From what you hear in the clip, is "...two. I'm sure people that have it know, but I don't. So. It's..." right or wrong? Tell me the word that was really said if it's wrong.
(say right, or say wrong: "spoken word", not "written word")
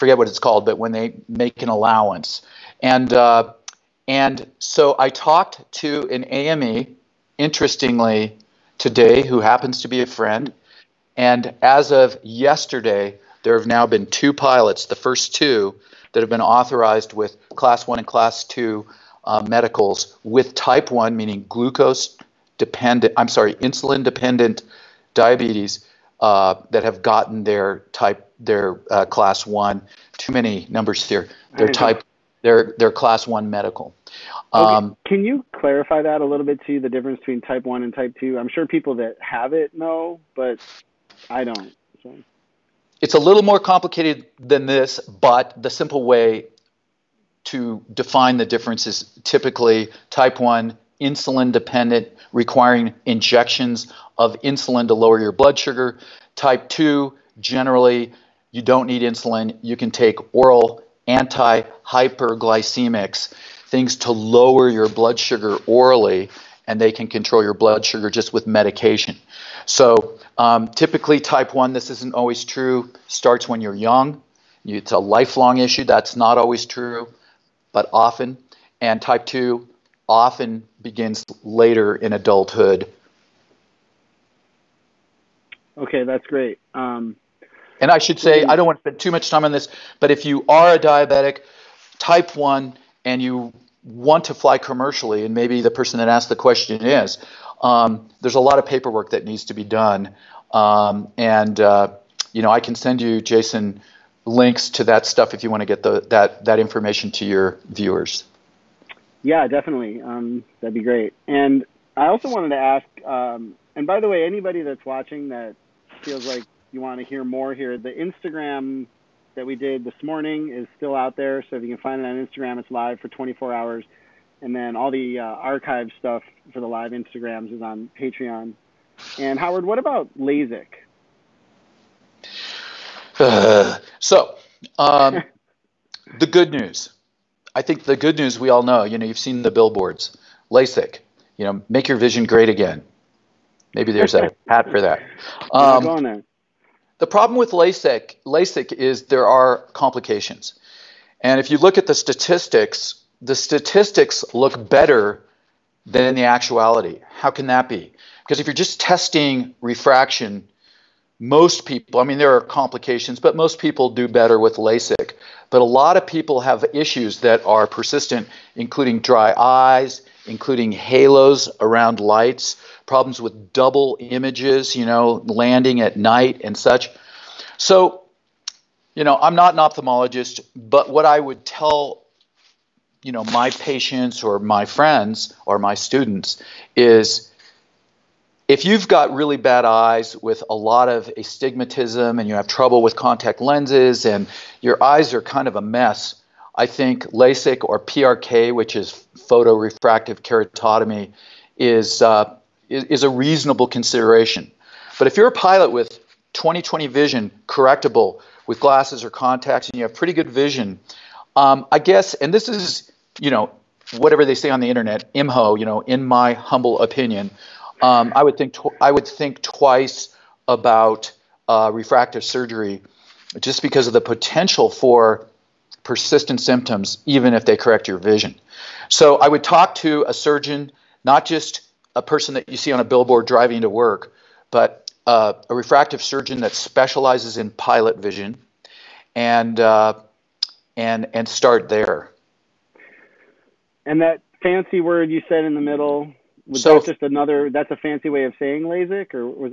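right.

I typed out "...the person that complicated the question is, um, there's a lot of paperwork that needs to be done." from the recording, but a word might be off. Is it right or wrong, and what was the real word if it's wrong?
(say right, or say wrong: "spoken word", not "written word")
wrong: "asked", not "complicated".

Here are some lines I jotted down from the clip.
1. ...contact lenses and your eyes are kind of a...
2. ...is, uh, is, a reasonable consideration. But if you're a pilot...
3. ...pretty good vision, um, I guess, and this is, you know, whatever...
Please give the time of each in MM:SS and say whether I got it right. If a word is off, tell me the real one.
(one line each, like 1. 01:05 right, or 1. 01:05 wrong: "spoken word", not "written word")
1. 03:12 right
2. 03:21 right
3. 03:29 right.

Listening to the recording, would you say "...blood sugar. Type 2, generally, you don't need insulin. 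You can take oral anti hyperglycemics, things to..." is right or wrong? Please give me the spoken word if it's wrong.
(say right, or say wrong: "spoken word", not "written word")
right.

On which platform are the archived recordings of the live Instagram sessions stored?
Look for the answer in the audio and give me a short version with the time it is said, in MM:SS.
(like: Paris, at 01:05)
Patreon, at 02:07.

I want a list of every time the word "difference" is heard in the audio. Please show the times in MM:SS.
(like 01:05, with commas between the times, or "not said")
00:36, 00:48.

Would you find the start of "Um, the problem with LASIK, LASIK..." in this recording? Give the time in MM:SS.
02:25.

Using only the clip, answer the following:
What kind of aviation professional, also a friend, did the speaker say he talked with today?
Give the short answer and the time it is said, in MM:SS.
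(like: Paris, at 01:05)
AME, at 00:06.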